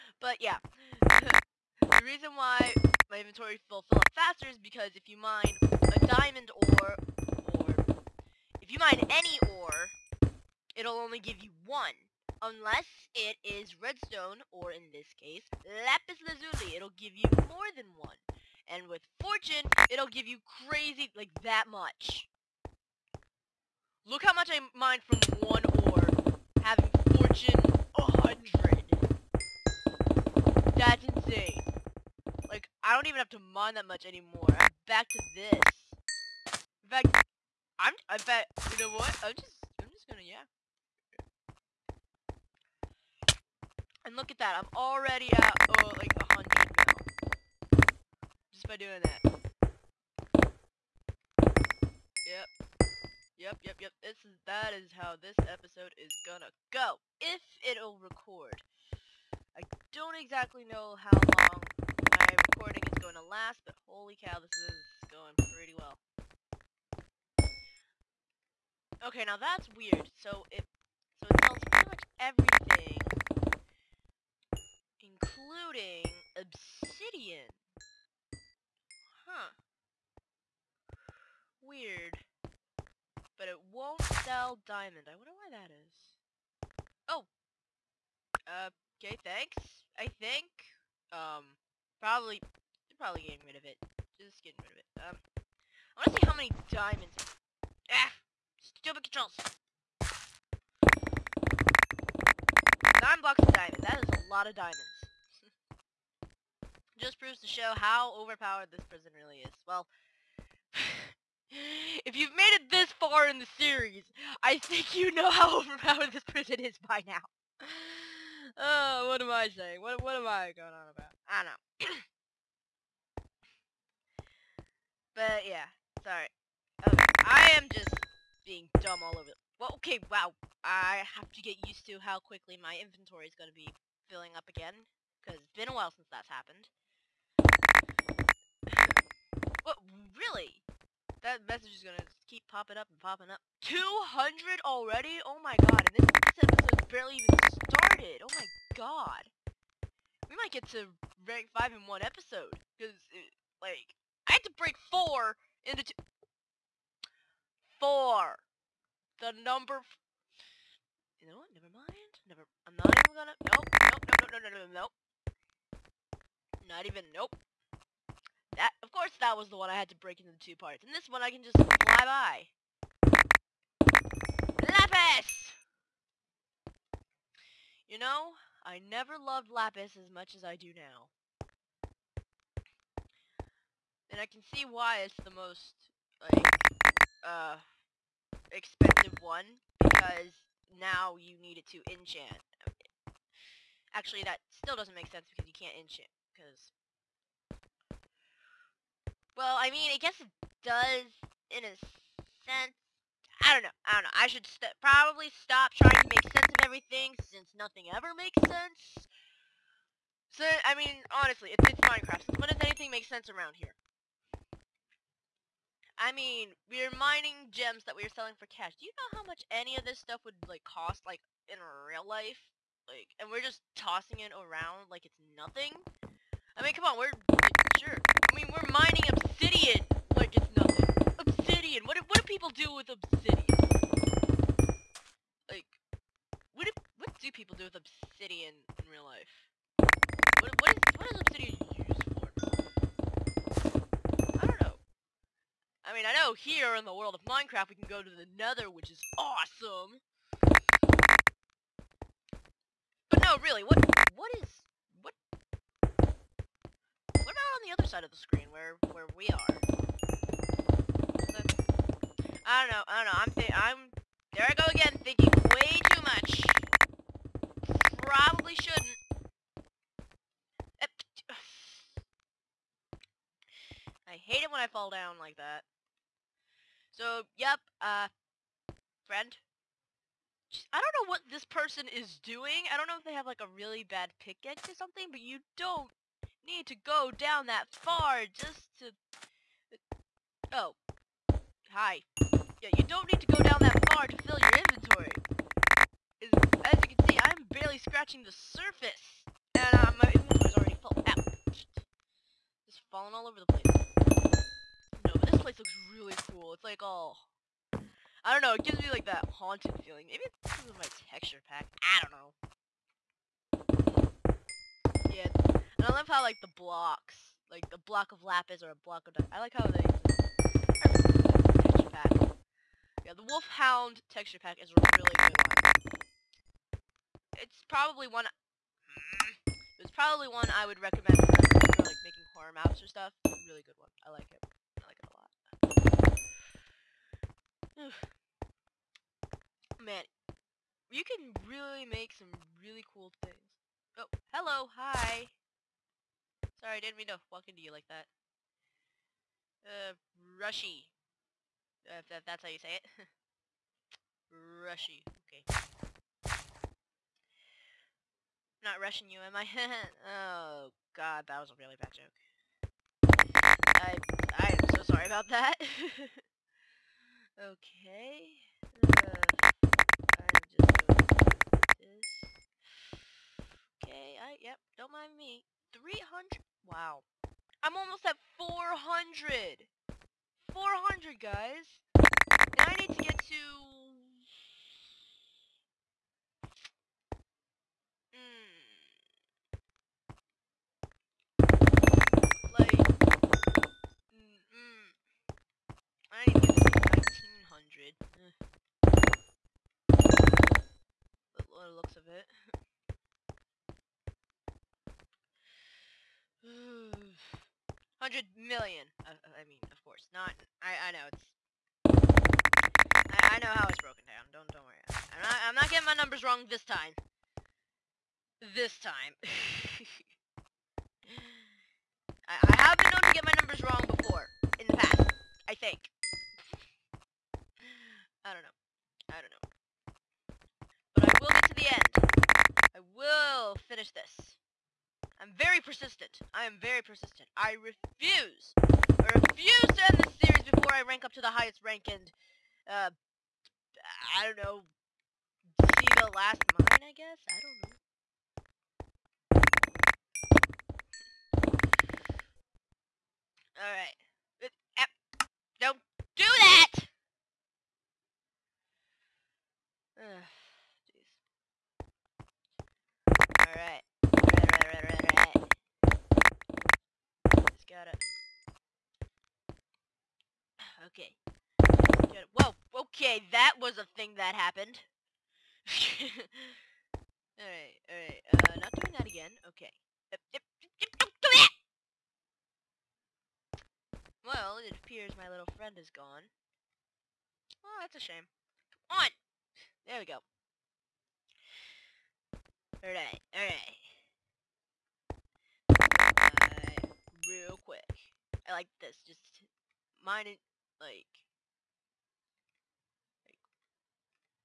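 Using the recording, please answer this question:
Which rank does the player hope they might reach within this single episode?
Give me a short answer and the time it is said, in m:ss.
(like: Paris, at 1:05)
5, at 2:31.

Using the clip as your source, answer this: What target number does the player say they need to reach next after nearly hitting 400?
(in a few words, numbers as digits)
1900.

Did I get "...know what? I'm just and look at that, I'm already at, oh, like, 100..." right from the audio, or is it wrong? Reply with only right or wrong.
right.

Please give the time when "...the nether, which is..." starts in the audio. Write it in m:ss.
4:08.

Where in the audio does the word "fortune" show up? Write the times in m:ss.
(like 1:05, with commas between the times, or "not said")
0:19, 0:27.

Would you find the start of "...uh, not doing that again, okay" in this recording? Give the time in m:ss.
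7:58.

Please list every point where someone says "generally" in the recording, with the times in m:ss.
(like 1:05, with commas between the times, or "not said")
not said.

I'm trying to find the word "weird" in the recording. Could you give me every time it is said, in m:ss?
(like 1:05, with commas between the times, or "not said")
1:09, 1:21.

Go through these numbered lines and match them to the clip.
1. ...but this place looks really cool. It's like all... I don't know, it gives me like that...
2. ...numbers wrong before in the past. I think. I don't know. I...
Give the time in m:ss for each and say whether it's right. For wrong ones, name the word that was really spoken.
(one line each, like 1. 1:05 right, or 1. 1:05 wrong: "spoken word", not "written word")
1. 5:05 right
2. 7:03 right.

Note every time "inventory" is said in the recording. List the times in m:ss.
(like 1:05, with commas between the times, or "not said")
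0:03, 2:12, 4:54.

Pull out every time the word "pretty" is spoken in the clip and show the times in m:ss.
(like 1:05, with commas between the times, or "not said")
1:05, 1:11.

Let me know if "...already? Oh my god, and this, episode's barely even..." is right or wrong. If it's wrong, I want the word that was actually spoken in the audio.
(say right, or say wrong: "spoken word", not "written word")
right.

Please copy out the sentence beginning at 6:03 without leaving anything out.
I, I am so sorry about that.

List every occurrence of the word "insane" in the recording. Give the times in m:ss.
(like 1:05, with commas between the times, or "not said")
0:31.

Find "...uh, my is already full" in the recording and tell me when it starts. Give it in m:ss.
4:59.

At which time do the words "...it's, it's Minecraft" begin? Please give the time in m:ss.
3:31.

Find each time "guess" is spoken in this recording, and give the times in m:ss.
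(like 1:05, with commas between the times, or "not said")
3:19, 7:26.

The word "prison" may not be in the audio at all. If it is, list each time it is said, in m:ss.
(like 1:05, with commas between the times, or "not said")
1:48, 1:56.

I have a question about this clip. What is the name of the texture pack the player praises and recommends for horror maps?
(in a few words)
Wolfhound.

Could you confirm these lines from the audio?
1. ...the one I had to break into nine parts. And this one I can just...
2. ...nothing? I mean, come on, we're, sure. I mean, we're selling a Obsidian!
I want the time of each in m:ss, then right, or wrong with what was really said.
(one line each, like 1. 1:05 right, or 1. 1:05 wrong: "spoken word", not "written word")
1. 2:49 wrong: "two", not "nine"
2. 3:45 wrong: "mining", not "selling".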